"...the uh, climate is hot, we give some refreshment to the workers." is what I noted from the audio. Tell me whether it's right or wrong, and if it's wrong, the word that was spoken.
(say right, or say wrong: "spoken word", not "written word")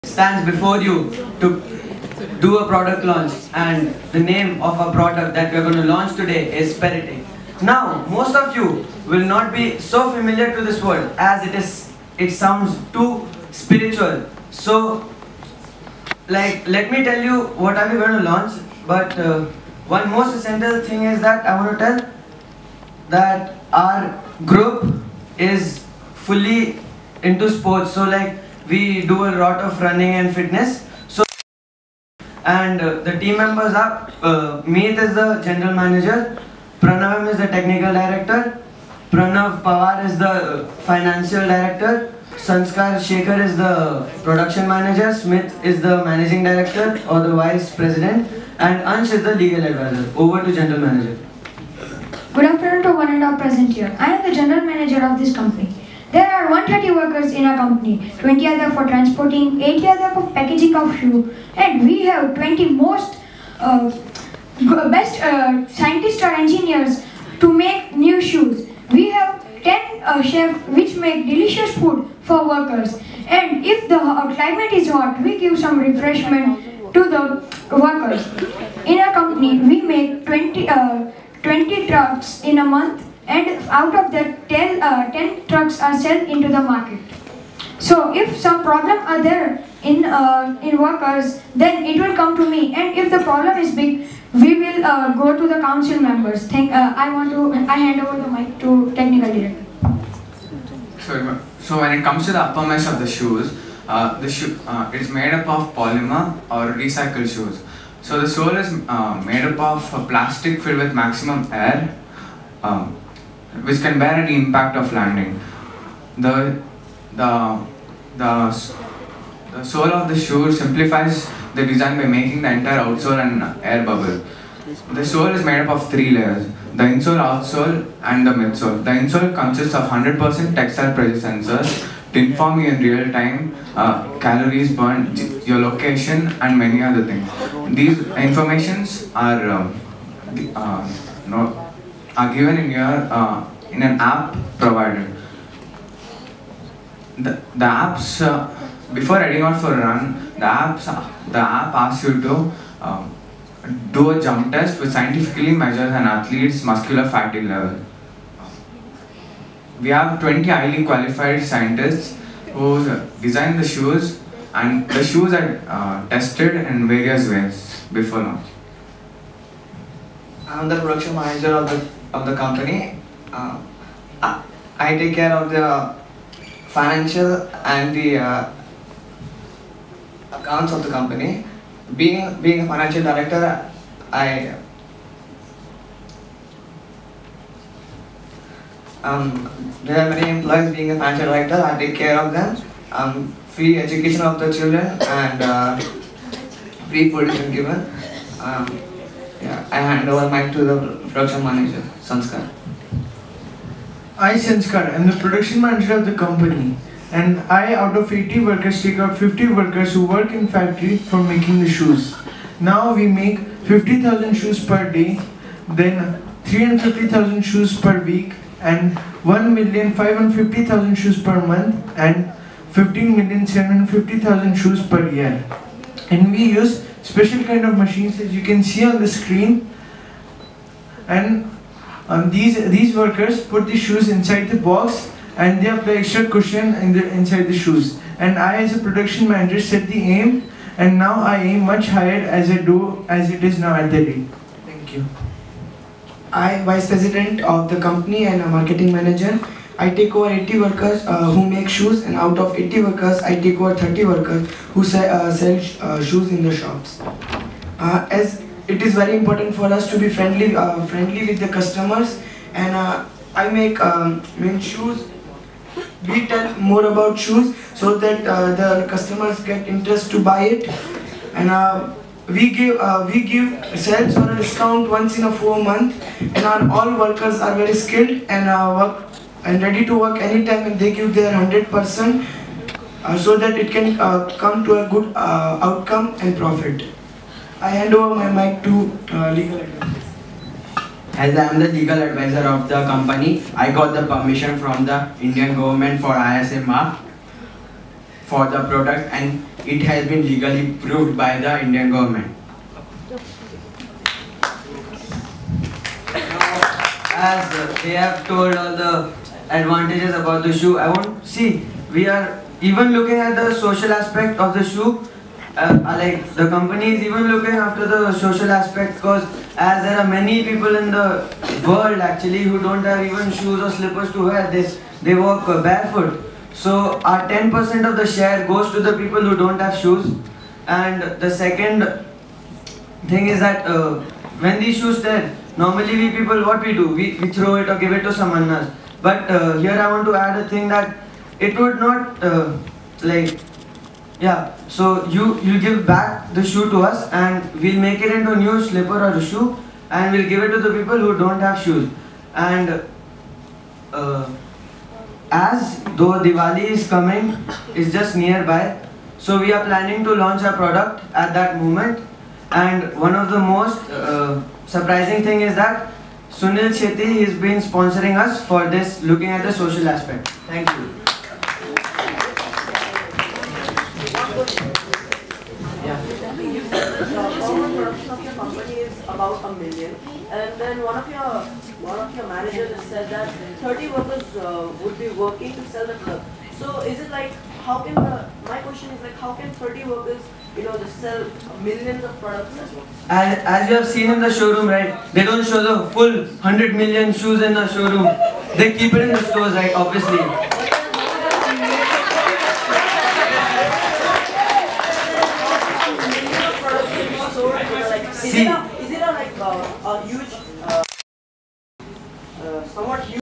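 right.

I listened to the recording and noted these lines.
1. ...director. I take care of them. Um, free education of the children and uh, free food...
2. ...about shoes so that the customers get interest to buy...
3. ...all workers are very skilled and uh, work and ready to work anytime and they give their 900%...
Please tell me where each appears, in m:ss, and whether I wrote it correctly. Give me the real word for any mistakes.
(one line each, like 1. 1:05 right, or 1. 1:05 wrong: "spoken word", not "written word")
1. 3:11 right
2. 4:26 right
3. 4:36 wrong: "100", not "900".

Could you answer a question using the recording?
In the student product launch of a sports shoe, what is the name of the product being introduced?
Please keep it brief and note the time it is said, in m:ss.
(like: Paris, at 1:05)
Peritic, at 0:06.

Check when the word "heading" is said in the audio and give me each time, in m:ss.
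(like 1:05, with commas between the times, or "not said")
2:29.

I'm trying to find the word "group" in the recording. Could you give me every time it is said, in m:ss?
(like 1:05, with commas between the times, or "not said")
0:24.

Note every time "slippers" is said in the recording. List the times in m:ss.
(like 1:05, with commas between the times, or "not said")
5:23, 5:48.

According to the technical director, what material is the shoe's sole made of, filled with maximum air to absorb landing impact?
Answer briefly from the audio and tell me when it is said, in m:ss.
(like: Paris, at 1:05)
plastic, at 1:50.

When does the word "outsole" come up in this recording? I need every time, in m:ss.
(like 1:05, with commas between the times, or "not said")
2:02, 2:07.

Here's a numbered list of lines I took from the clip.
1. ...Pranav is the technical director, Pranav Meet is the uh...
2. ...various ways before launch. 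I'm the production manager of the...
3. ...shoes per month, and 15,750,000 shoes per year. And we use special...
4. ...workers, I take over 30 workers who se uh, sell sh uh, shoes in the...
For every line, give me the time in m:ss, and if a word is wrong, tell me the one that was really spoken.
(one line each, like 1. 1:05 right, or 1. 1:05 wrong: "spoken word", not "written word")
1. 0:36 wrong: "Pawar", not "Meet"
2. 2:46 right
3. 3:40 right
4. 4:12 right.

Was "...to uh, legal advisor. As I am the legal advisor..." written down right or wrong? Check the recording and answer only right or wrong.
right.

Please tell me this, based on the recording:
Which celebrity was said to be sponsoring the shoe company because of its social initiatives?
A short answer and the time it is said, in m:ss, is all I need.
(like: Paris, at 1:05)
Sunil Shetty, at 6:06.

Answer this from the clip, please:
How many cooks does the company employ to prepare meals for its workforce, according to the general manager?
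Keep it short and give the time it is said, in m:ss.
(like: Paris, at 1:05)
10, at 1:09.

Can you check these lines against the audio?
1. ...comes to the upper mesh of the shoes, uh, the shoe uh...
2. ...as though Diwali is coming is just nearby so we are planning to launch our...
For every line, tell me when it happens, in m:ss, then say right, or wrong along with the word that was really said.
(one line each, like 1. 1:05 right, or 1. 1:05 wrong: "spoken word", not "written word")
1. 1:42 right
2. 5:55 right.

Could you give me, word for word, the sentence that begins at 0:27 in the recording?
So like we do a lot of running and fitness.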